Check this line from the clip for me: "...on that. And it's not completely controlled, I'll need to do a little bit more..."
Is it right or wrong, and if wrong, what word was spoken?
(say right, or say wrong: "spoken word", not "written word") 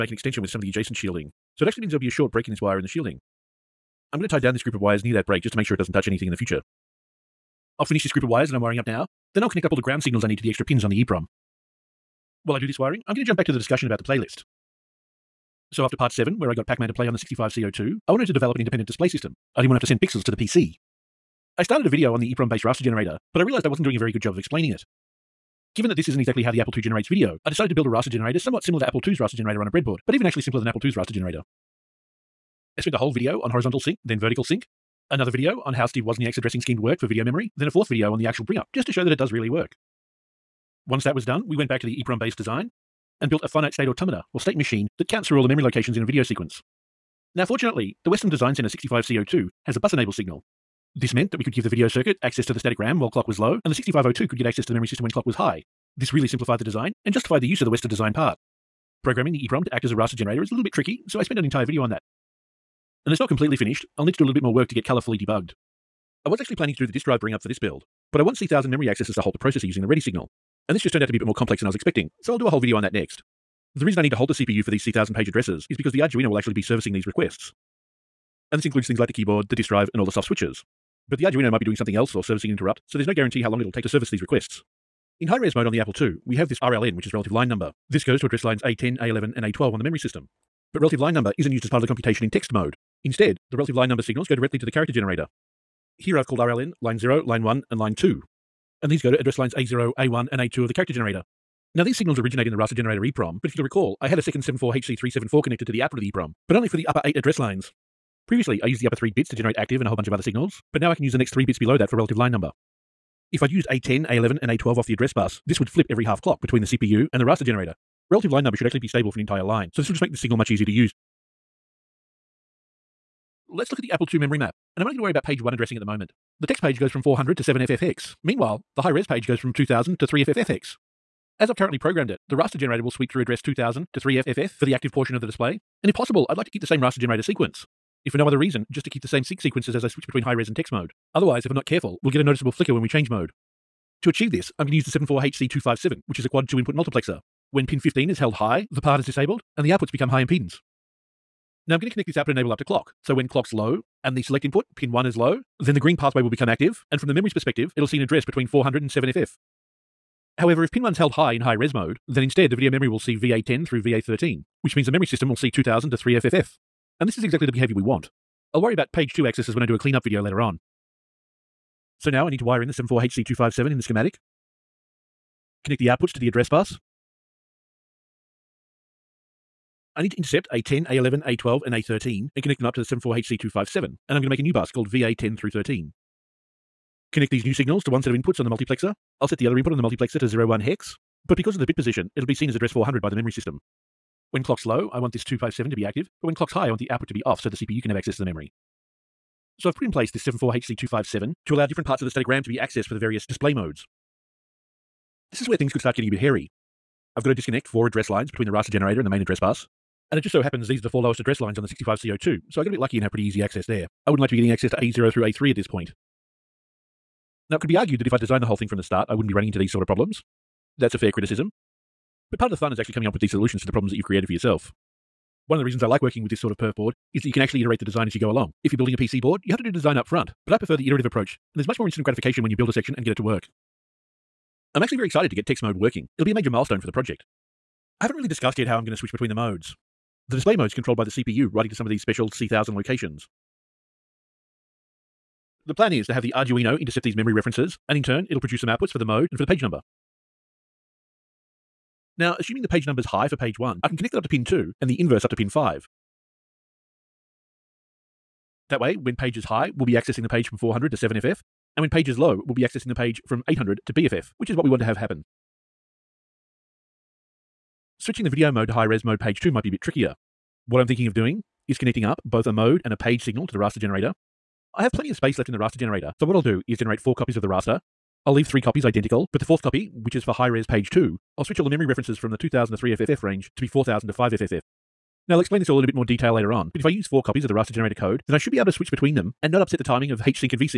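wrong: "finished", not "controlled".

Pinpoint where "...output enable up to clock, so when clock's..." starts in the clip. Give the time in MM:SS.
02:32.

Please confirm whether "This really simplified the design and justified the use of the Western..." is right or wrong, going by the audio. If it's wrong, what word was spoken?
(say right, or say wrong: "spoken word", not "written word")
right.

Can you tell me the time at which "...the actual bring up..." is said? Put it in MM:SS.
00:38.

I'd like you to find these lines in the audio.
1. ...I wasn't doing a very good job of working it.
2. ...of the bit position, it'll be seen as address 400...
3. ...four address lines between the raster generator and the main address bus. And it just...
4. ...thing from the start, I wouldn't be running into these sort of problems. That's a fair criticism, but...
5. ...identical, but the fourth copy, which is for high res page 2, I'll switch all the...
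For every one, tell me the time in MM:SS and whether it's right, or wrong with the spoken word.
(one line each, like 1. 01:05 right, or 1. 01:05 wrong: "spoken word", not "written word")
1. 00:23 wrong: "explaining", not "working"
2. 03:11 right
3. 03:27 right
4. 03:38 right
5. 04:38 right.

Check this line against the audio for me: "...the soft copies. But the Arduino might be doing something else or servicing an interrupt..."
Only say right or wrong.
wrong.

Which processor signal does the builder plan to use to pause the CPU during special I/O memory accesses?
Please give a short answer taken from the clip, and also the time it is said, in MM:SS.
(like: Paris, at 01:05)
ready signal, at 01:09.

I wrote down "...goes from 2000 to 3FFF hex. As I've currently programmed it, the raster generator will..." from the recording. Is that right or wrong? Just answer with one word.
right.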